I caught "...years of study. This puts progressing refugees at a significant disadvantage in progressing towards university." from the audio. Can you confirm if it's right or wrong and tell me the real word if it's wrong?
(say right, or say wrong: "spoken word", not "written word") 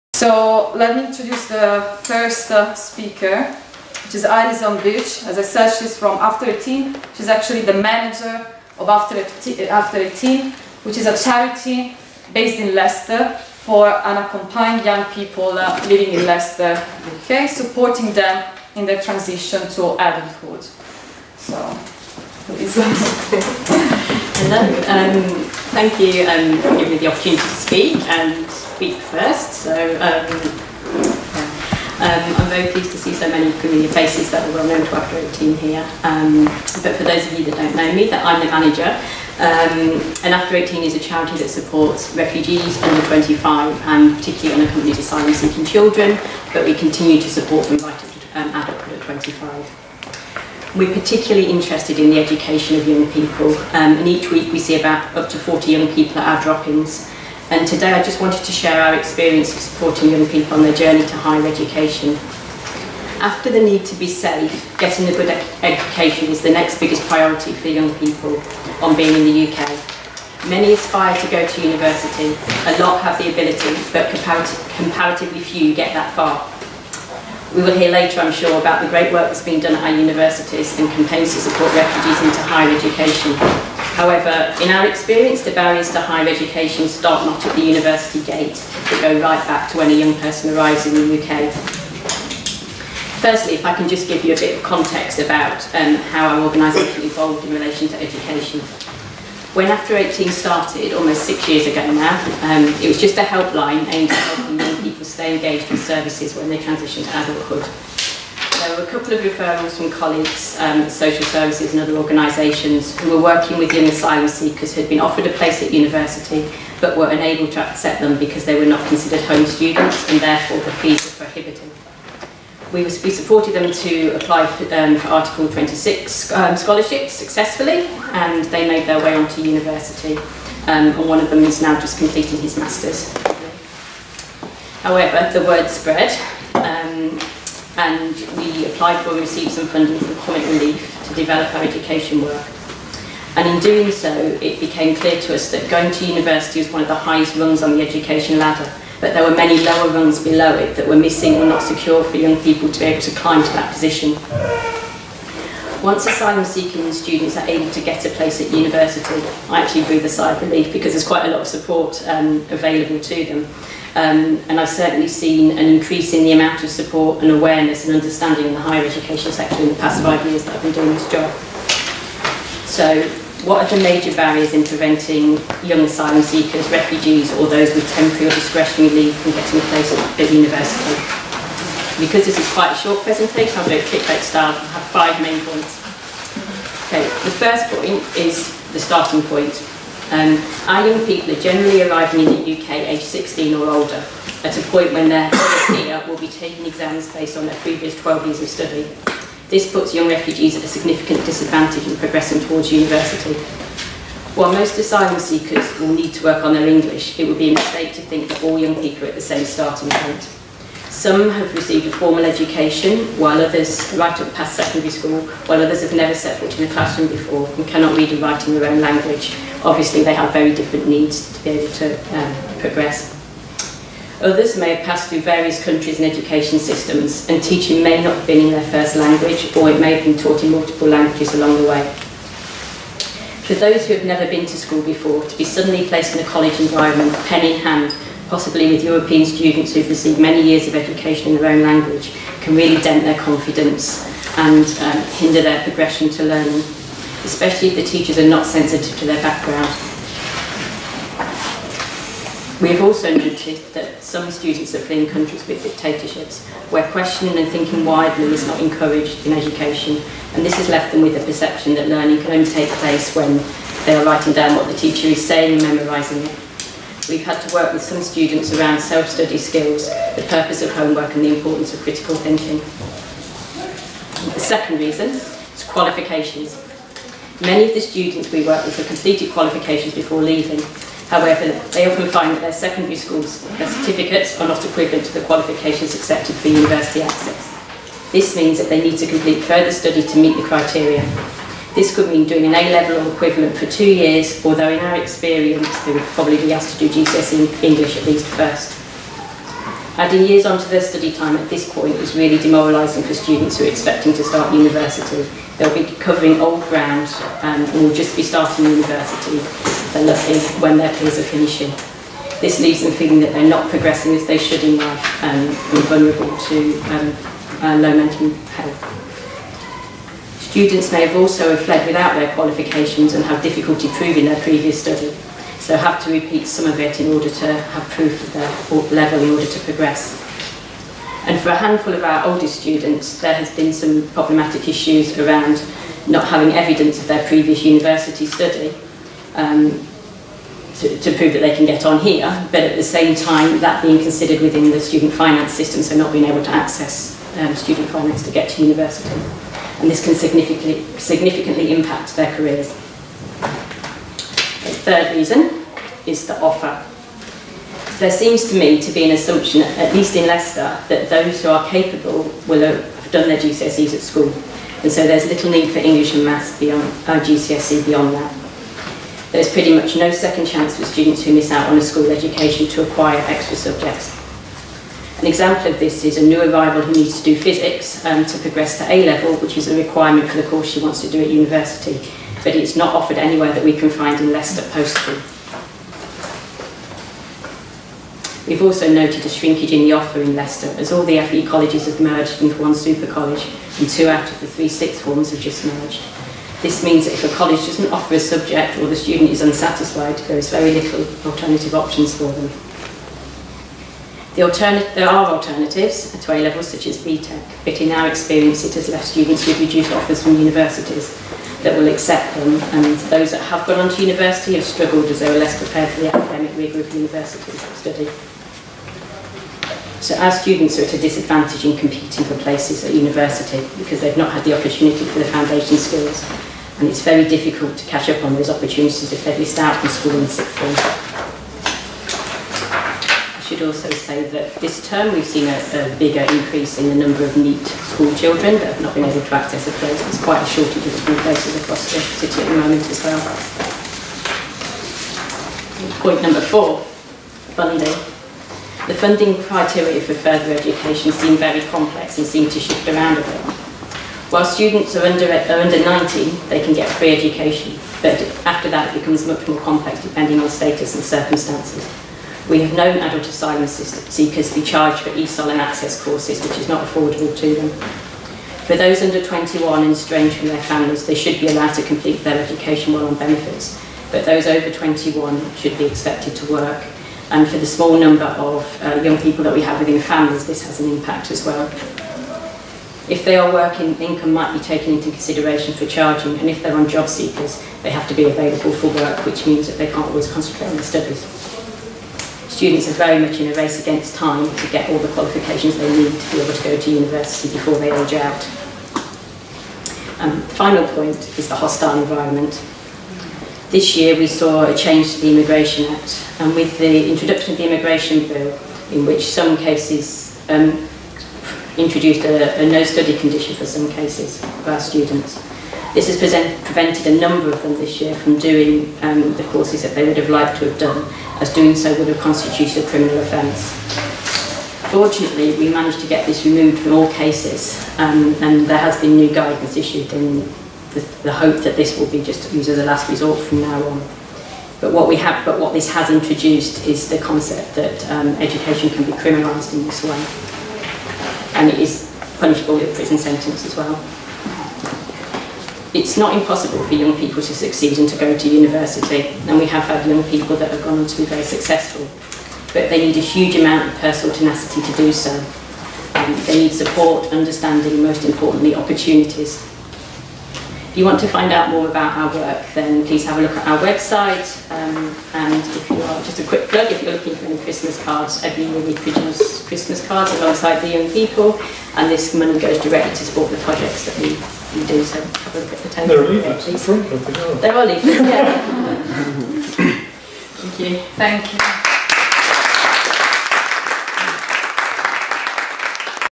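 wrong: "young", not "progressing".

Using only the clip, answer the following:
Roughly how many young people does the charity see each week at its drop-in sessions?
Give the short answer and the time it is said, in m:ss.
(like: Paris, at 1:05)
40, at 0:55.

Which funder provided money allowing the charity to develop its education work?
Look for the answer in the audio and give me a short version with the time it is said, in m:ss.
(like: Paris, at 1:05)
Comic Relief, at 2:20.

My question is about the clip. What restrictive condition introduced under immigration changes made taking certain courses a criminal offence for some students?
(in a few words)
No study condition.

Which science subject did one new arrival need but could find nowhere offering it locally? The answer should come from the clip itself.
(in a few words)
Physics.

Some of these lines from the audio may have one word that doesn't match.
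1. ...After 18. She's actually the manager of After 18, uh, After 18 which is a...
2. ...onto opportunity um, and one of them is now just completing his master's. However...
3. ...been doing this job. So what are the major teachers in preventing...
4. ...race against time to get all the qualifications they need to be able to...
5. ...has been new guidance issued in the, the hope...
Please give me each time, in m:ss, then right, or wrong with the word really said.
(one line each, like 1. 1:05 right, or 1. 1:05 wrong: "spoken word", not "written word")
1. 0:06 right
2. 2:09 wrong: "university", not "opportunity"
3. 2:50 wrong: "barriers", not "teachers"
4. 8:13 right
5. 8:48 right.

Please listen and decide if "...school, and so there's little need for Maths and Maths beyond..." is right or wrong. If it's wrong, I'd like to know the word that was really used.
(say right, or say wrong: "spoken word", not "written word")
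wrong: "English", not "Maths".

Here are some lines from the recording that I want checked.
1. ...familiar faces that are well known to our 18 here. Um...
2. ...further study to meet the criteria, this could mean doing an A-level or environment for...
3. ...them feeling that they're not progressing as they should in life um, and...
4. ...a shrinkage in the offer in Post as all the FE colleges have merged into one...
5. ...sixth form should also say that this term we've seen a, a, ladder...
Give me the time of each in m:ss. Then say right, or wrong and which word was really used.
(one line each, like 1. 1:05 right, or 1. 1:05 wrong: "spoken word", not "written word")
1. 0:33 right
2. 4:49 wrong: "equivalent", not "environment"
3. 5:12 right
4. 6:29 wrong: "Leicester", not "Post"
5. 7:10 wrong: "bigger", not "ladder".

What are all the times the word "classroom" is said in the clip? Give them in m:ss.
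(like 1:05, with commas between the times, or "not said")
3:36.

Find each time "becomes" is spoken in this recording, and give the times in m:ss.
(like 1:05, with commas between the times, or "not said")
7:39.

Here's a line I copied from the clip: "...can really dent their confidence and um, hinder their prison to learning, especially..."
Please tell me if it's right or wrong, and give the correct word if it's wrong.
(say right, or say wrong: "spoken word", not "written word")
wrong: "progression", not "prison".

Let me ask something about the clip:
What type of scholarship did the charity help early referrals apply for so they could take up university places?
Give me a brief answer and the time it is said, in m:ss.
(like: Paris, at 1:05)
Article 26, at 2:05.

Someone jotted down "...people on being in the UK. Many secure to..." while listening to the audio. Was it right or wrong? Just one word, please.
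wrong.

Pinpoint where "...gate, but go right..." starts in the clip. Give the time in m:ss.
1:28.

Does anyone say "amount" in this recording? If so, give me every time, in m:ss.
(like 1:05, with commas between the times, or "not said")
2:46, 9:13.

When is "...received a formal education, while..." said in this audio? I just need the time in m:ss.
3:31.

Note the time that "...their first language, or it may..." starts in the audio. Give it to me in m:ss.
3:48.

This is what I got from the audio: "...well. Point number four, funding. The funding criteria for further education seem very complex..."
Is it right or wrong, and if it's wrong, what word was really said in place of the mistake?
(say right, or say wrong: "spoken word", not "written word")
right.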